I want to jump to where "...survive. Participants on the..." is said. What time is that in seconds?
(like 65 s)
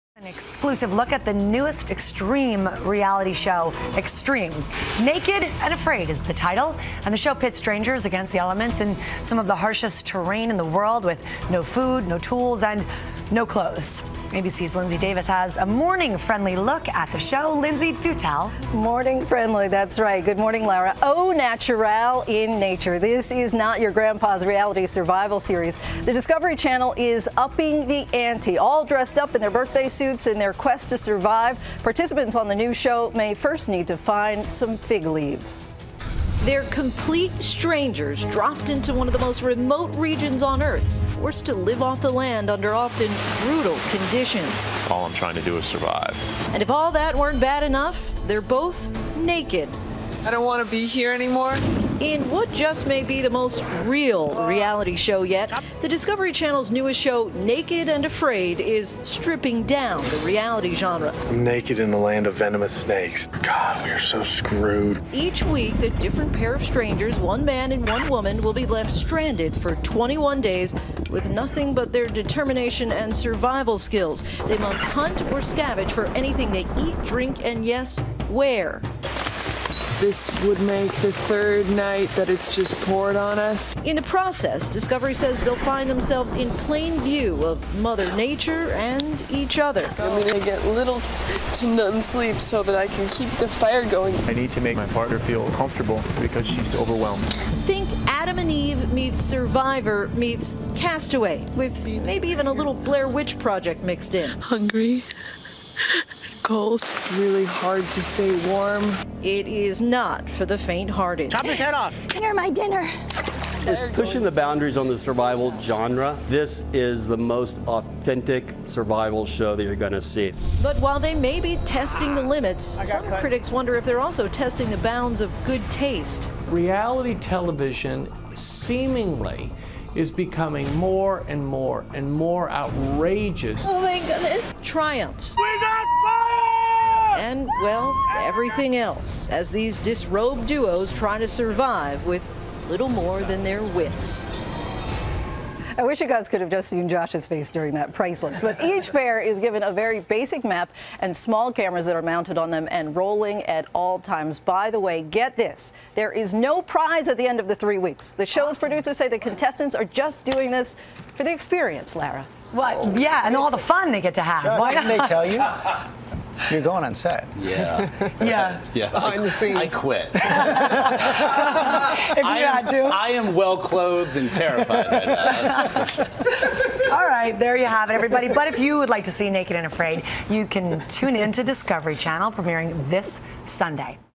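30 s.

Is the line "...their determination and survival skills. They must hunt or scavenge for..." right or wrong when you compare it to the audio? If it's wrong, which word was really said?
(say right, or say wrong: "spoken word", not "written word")
right.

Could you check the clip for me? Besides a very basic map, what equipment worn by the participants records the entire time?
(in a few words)
small cameras.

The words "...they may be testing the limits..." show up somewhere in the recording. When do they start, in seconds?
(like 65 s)
120 s.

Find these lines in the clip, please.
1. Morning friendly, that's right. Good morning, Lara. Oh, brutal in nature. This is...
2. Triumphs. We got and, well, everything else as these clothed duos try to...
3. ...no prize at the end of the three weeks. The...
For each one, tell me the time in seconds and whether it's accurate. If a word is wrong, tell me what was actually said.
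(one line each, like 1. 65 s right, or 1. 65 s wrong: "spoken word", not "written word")
1. 18 s wrong: "natural", not "brutal"
2. 134 s wrong: "disrobed", not "clothed"
3. 156 s right.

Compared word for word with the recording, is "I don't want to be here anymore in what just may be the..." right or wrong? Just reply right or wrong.
right.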